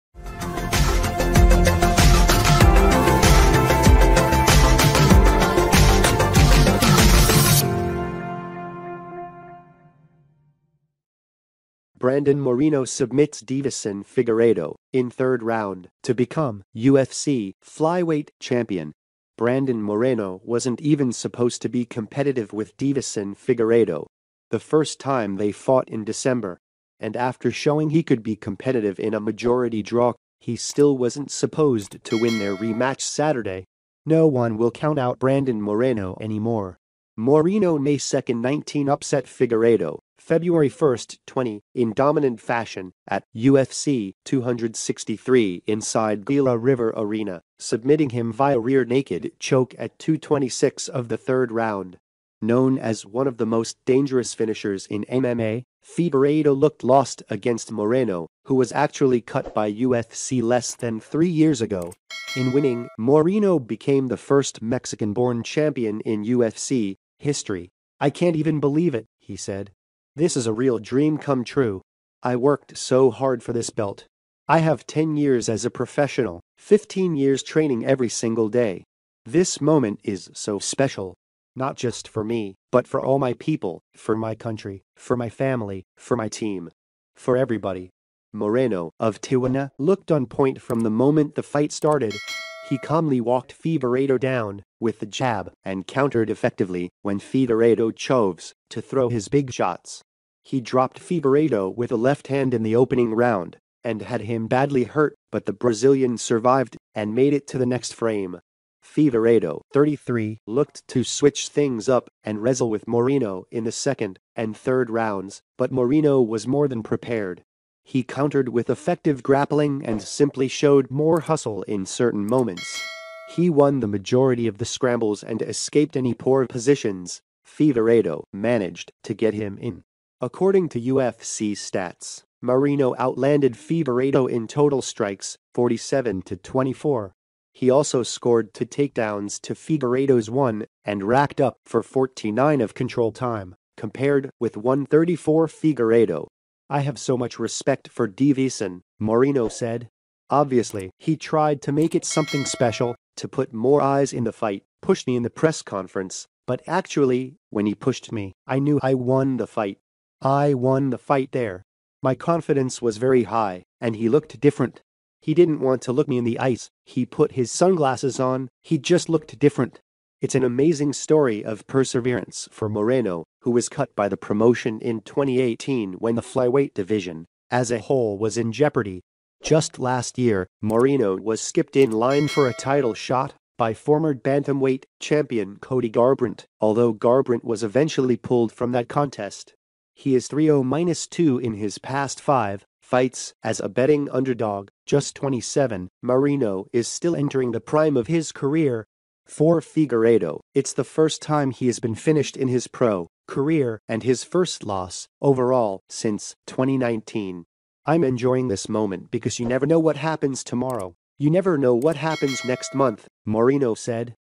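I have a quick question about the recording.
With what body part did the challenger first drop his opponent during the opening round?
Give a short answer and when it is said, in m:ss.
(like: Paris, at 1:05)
left hand, at 1:41.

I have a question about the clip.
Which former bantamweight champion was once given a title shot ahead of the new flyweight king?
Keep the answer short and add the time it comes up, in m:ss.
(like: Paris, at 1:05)
Cody Garbrandt, at 3:05.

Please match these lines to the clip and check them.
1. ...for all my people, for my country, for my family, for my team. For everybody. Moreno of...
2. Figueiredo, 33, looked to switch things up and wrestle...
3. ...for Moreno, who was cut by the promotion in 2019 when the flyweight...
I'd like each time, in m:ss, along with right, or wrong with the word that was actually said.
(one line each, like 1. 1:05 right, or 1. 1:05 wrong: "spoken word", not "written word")
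1. 1:22 right
2. 1:48 right
3. 2:52 wrong: "2018", not "2019".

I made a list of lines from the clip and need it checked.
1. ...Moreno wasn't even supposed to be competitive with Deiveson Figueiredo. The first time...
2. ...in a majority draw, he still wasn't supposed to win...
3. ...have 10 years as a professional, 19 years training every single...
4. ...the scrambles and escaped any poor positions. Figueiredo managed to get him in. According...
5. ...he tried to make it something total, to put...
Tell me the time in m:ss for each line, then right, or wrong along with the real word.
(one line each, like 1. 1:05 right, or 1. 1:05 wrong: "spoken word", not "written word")
1. 0:19 right
2. 0:28 right
3. 1:14 wrong: "15", not "19"
4. 2:04 right
5. 2:30 wrong: "special", not "total".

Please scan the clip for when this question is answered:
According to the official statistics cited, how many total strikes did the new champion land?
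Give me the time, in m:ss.
2:15.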